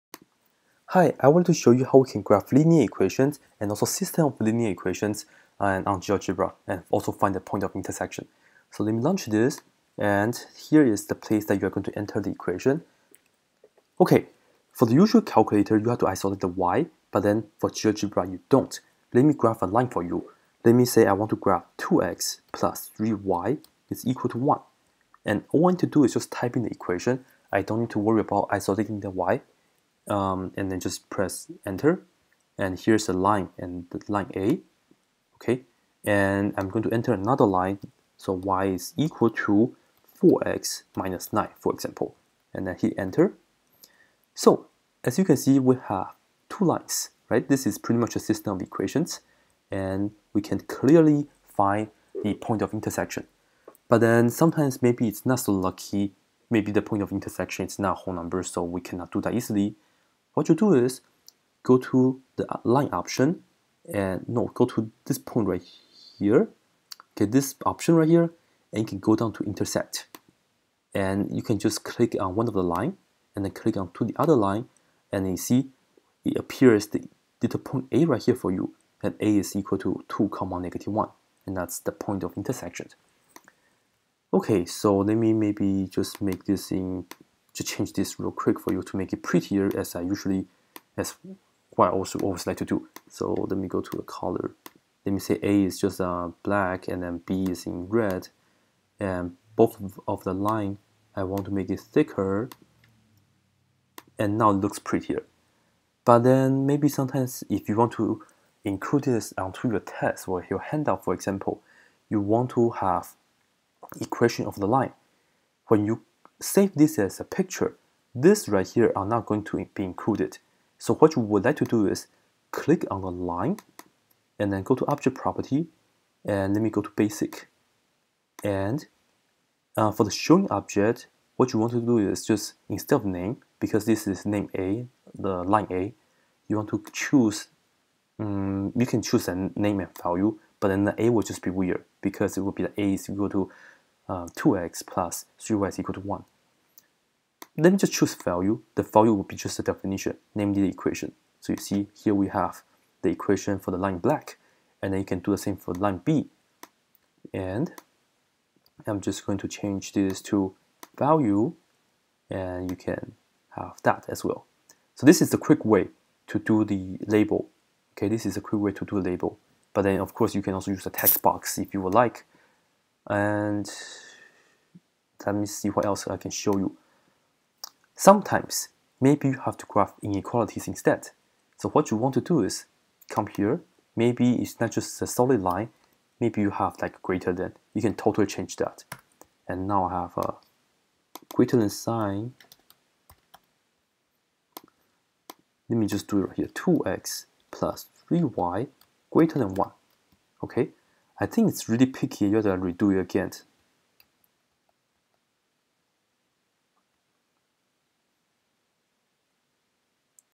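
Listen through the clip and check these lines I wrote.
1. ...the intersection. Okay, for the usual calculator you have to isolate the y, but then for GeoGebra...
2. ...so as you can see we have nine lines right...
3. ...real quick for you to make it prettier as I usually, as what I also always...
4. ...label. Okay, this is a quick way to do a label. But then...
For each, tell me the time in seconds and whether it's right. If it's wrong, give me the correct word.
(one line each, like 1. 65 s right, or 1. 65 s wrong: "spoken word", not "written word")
1. 12 s wrong: "equation", not "intersection"
2. 44 s wrong: "two", not "nine"
3. 88 s right
4. 167 s right.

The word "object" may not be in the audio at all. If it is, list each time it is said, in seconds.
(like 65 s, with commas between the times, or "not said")
124 s, 130 s.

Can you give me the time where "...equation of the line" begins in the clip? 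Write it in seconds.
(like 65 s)
113 s.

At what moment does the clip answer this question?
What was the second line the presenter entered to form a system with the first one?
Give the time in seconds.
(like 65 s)
38 s.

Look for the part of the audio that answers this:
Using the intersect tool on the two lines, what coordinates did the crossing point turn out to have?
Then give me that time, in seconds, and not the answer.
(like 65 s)
80 s.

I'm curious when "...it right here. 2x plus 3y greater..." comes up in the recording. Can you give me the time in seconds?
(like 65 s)
196 s.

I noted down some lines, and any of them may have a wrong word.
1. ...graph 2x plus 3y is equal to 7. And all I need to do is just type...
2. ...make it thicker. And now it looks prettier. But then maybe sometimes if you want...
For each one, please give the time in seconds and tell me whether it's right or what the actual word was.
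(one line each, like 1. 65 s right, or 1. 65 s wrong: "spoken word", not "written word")
1. 21 s wrong: "1", not "7"
2. 101 s right.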